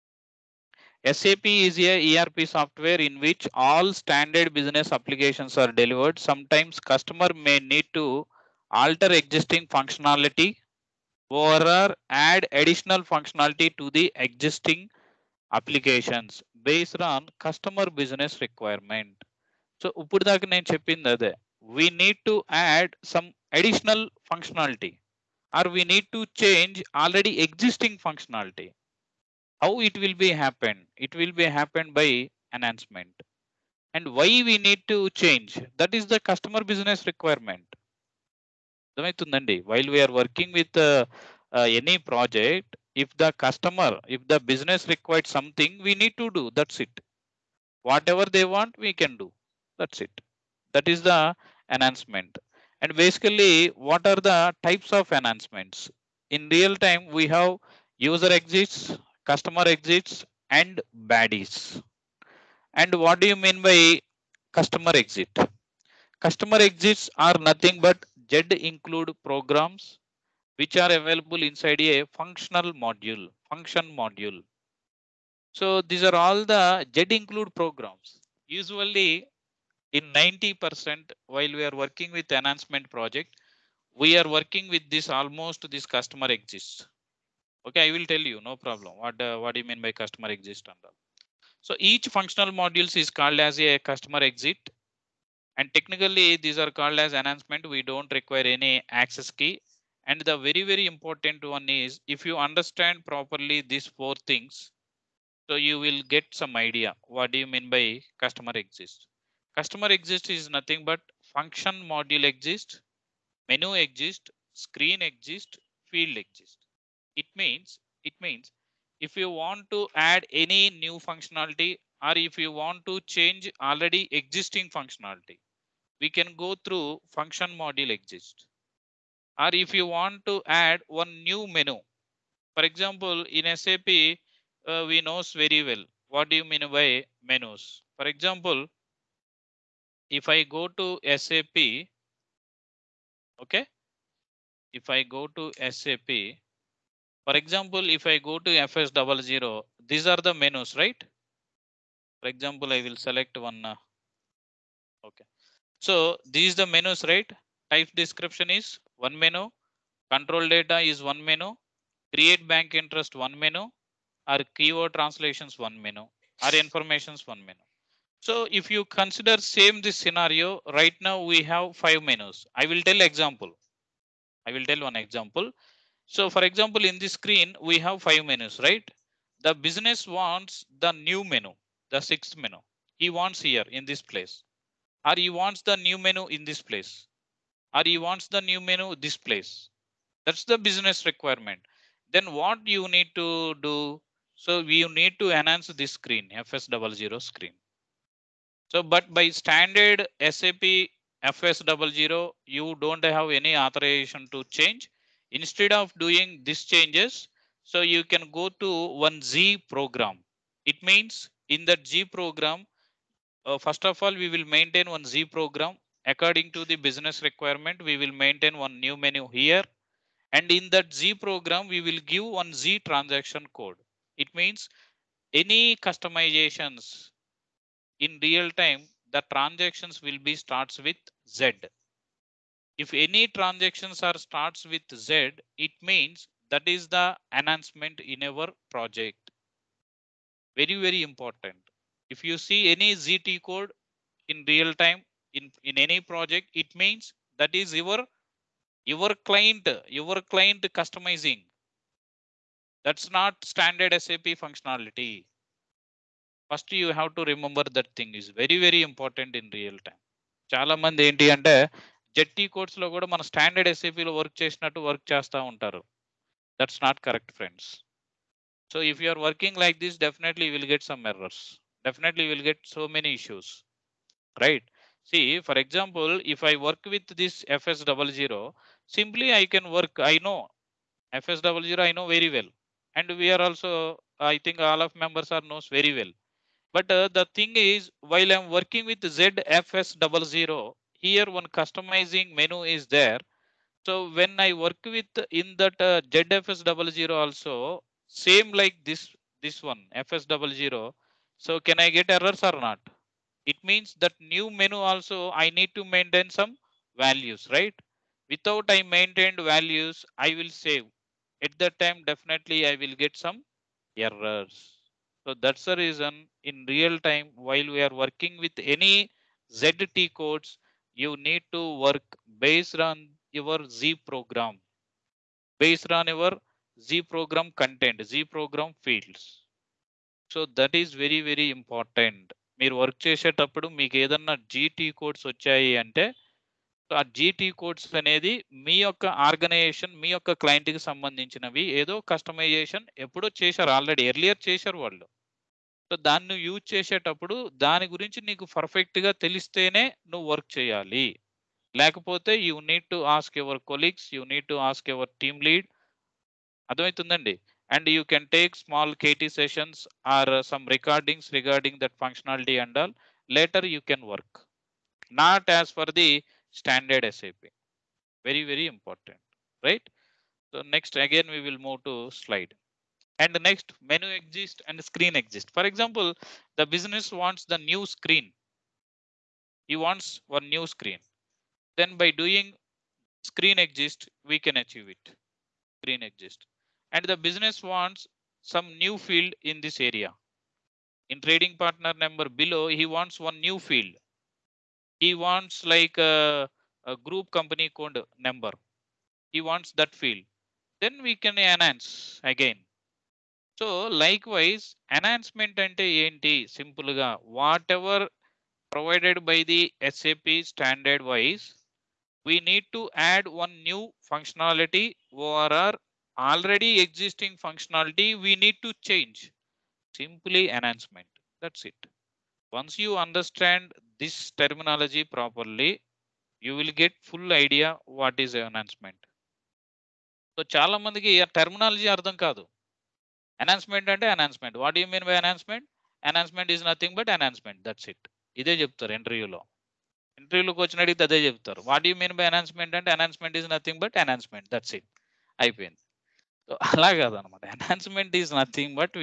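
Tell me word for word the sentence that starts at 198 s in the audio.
So, but by standard SAP FS00, you don't have any authorization to change.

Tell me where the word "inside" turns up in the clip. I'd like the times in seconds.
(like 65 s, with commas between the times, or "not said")
71 s.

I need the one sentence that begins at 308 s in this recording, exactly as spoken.
Without I maintained values, I will save.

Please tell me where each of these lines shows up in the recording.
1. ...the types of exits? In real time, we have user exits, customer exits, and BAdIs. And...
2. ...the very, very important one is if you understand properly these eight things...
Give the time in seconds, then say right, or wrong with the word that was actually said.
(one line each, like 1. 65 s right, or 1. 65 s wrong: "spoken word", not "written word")
1. 54 s wrong: "enhancements", not "exits"
2. 100 s wrong: "four", not "eight".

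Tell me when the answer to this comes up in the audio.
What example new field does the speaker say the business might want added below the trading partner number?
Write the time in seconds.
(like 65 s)
396 s.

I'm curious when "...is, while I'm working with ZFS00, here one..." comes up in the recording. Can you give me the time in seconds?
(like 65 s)
287 s.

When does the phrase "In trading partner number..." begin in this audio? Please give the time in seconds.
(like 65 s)
391 s.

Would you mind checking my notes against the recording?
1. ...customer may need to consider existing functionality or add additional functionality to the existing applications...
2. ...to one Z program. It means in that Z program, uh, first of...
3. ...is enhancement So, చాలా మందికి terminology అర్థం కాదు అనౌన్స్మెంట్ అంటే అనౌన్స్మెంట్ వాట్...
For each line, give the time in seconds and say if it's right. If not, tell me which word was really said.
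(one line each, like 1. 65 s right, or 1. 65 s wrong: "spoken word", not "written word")
1. 6 s wrong: "alter", not "consider"
2. 208 s right
3. 428 s right.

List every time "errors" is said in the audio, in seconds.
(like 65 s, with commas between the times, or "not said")
302 s, 313 s.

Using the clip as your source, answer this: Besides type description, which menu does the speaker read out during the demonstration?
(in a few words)
Control data.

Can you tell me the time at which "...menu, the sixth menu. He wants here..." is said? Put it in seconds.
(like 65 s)
181 s.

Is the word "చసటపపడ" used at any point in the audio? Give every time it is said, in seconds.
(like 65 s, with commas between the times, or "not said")
333 s, 346 s.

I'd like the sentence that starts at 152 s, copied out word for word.
For example, I will select one.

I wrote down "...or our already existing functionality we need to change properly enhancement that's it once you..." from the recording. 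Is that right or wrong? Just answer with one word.
wrong.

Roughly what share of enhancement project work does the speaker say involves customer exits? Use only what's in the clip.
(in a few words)
90%.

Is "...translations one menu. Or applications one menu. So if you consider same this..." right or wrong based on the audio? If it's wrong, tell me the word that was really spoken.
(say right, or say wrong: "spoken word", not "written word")
wrong: "informations", not "applications".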